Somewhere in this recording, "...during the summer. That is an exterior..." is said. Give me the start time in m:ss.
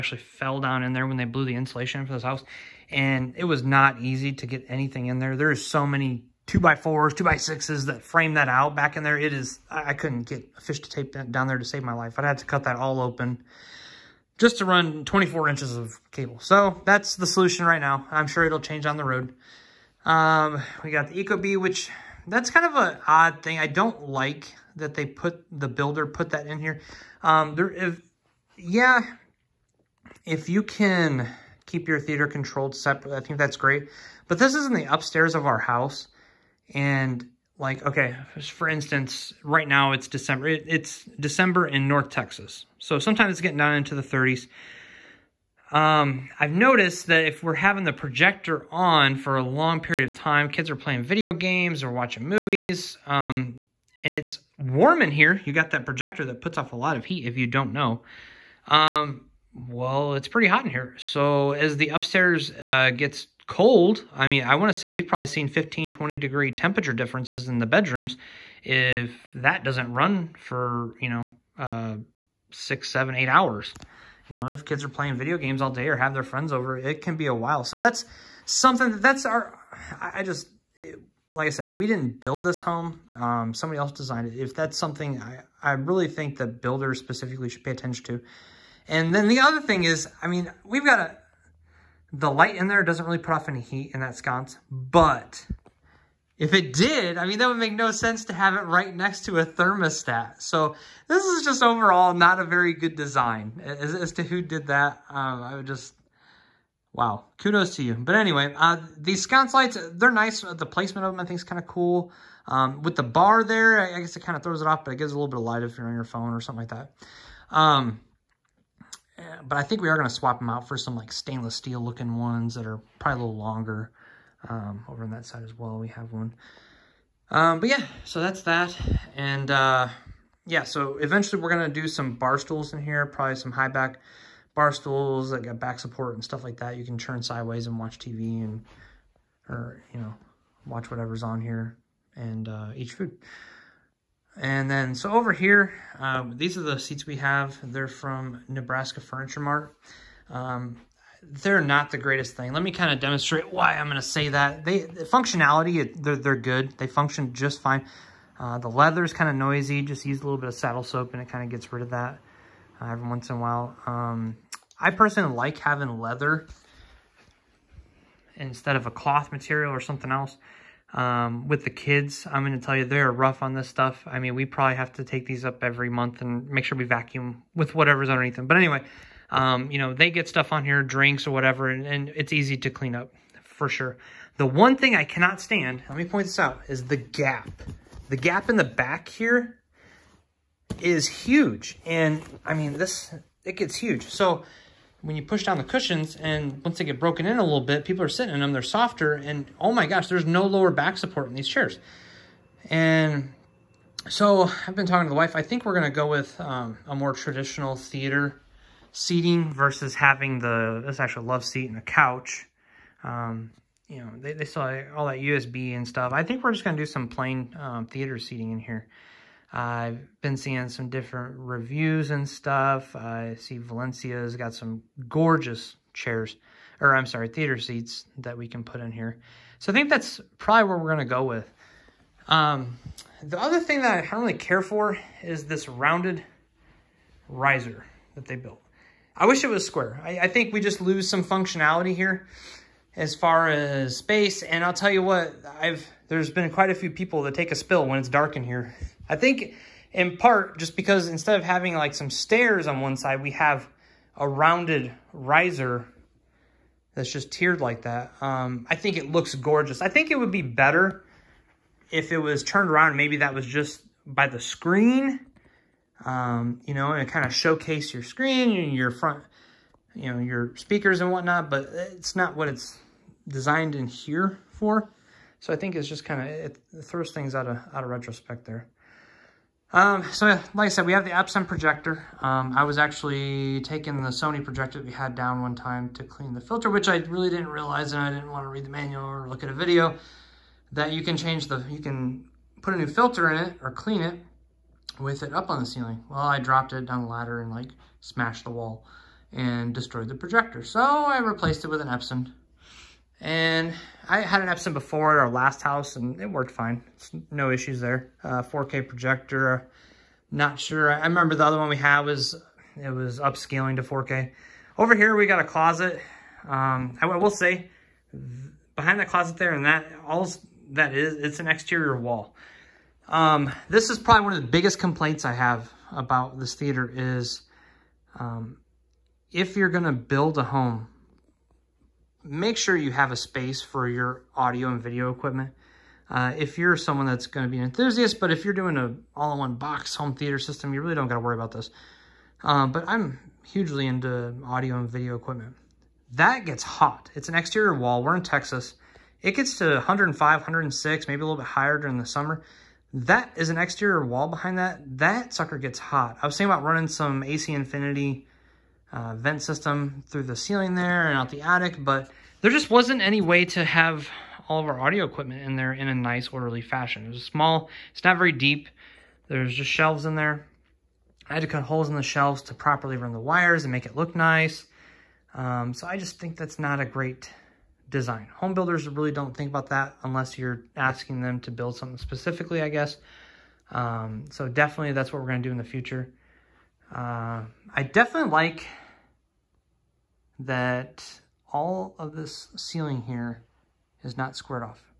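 5:51.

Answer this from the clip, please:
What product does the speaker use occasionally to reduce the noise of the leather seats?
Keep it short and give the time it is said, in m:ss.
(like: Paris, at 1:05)
saddle soap, at 2:40.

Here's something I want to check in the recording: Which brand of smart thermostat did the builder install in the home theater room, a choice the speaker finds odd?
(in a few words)
Ecobee.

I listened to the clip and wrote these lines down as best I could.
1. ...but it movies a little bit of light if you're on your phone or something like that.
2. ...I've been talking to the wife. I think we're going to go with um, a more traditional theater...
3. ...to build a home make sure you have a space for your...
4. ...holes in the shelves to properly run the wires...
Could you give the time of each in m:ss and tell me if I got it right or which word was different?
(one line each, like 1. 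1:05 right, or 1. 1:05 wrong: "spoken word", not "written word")
1. 1:54 wrong: "gives", not "movies"
2. 3:24 right
3. 5:29 right
4. 6:11 right.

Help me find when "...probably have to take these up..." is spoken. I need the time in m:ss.
2:54.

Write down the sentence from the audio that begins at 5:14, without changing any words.
Over here, we got a closet.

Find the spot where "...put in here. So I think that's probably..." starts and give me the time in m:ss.
3:48.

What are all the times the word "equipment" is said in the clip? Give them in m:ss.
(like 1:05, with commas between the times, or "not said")
5:35, 5:45, 6:05.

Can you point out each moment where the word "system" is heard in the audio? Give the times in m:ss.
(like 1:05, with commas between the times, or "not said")
5:40, 5:59.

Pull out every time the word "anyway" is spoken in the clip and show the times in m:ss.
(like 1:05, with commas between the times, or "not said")
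1:48, 2:58.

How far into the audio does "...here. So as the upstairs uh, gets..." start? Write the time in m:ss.
1:00.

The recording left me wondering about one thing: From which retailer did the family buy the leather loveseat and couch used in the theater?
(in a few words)
Nebraska Furniture Mart.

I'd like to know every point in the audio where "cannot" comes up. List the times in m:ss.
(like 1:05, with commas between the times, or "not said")
3:05.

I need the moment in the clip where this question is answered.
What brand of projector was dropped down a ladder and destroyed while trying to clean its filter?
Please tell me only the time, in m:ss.
4:44.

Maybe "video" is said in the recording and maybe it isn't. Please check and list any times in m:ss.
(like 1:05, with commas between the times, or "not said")
0:51, 1:15, 4:49, 5:34, 5:44.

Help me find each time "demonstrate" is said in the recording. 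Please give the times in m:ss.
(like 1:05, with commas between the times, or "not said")
2:33.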